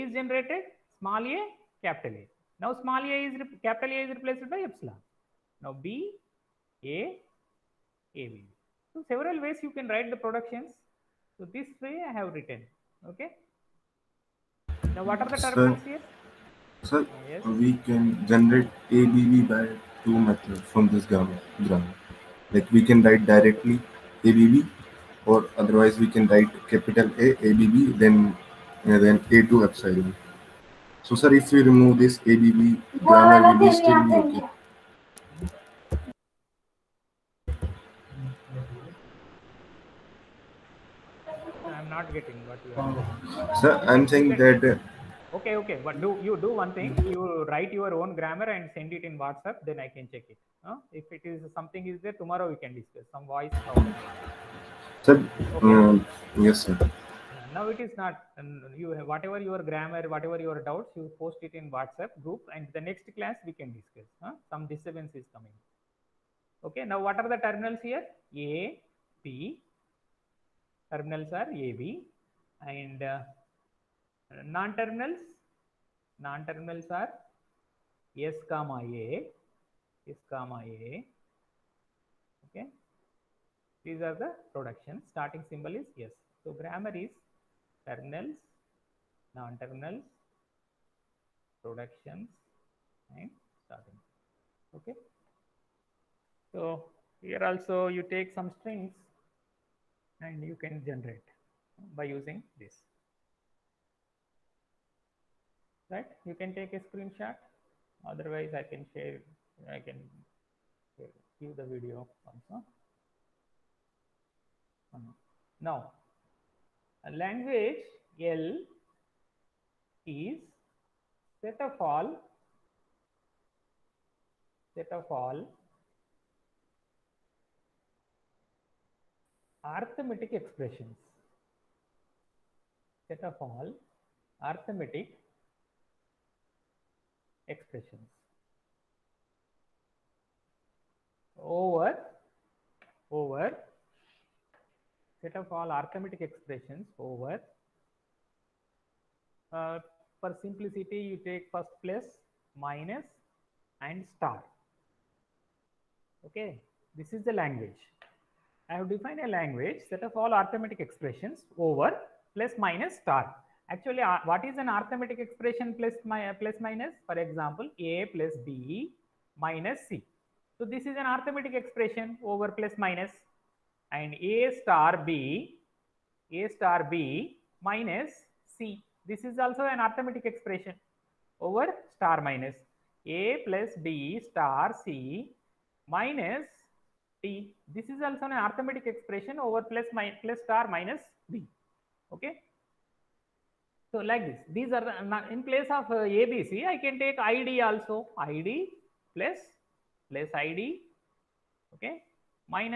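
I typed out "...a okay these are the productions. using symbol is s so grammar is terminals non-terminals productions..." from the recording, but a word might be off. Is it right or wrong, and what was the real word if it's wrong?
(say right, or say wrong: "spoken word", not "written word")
wrong: "starting", not "using".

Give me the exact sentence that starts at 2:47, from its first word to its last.
For example, A plus B minus C.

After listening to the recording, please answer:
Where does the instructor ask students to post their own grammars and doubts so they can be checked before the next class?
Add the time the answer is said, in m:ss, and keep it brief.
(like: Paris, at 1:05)
WhatsApp group, at 1:01.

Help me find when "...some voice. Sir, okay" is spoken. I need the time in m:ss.
0:53.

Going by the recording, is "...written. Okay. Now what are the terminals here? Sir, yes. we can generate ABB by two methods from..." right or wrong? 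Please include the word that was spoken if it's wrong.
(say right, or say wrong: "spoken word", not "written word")
right.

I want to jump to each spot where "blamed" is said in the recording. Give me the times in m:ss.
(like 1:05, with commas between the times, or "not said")
not said.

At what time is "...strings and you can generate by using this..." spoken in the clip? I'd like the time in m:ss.
1:38.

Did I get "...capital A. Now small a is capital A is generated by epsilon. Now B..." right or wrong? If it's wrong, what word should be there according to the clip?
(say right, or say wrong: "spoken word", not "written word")
wrong: "replaced", not "generated".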